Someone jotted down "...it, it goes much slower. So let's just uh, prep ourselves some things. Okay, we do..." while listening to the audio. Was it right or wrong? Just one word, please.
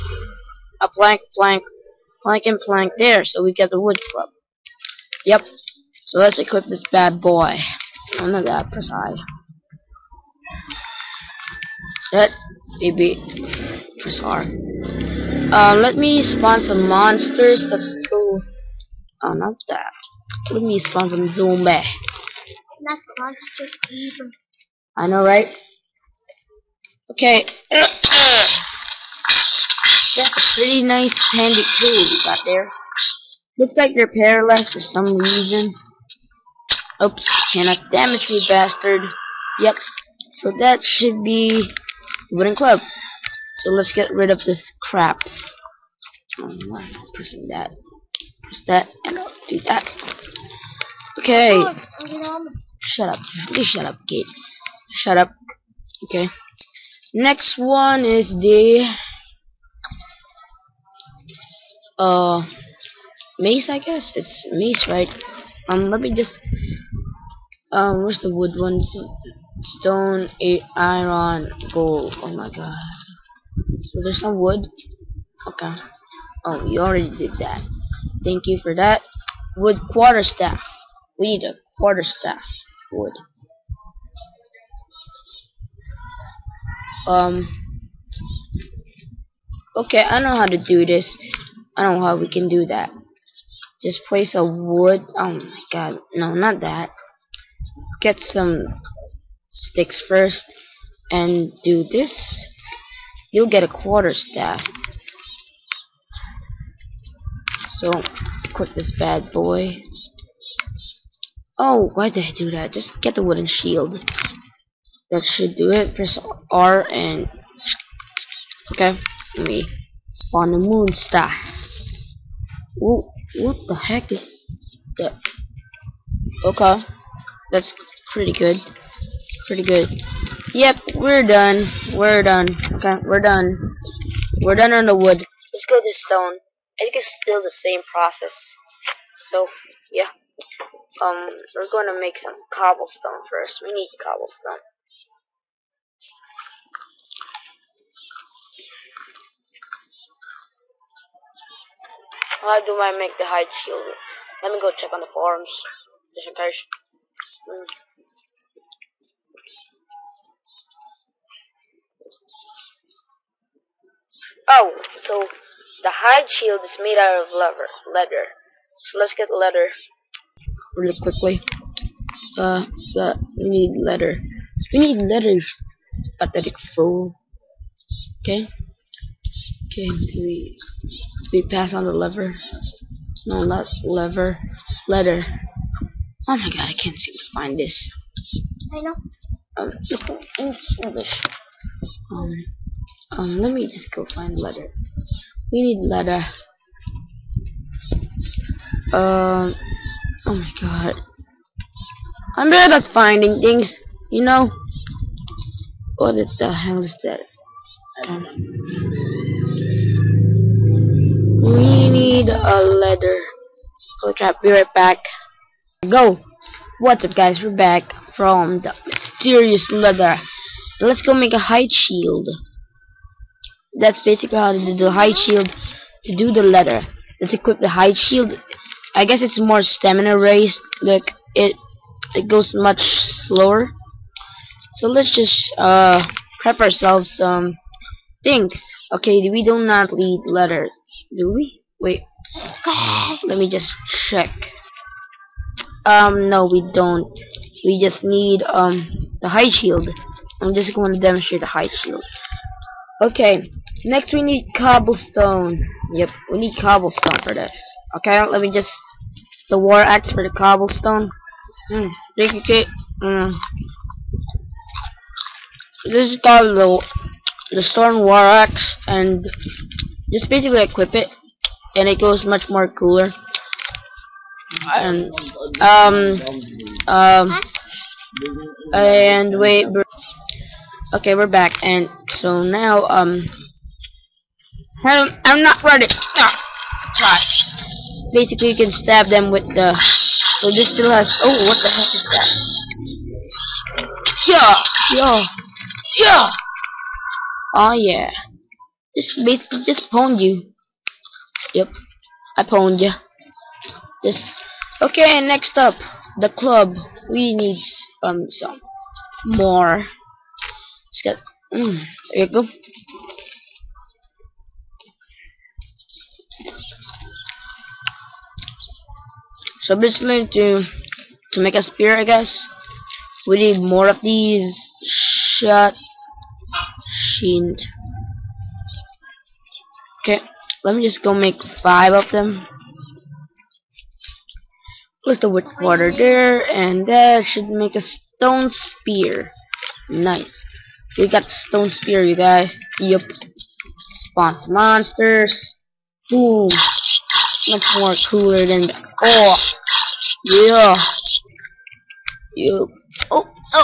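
right.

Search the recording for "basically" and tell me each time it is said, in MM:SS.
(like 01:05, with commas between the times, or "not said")
03:44, 04:30, 04:48, 04:59, 05:19.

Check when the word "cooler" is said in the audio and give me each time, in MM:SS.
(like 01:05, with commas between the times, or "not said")
04:32, 05:48.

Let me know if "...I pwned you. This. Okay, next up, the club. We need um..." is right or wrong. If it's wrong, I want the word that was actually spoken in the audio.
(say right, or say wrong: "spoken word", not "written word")
right.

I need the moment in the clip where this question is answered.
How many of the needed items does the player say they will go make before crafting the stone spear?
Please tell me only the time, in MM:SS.
05:31.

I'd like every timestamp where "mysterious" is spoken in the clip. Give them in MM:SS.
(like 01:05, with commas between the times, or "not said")
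03:38.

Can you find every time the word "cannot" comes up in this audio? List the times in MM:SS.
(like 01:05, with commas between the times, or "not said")
00:37.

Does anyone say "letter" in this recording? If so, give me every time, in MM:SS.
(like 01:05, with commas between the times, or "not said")
03:46, 04:00.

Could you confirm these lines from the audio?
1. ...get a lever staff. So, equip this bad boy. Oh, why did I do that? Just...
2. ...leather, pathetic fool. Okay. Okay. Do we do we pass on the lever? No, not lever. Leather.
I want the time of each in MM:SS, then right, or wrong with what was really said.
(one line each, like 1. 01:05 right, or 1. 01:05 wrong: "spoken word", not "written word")
1. 01:43 wrong: "quarter", not "lever"
2. 02:54 right.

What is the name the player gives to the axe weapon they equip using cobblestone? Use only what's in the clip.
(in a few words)
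Storm war axe.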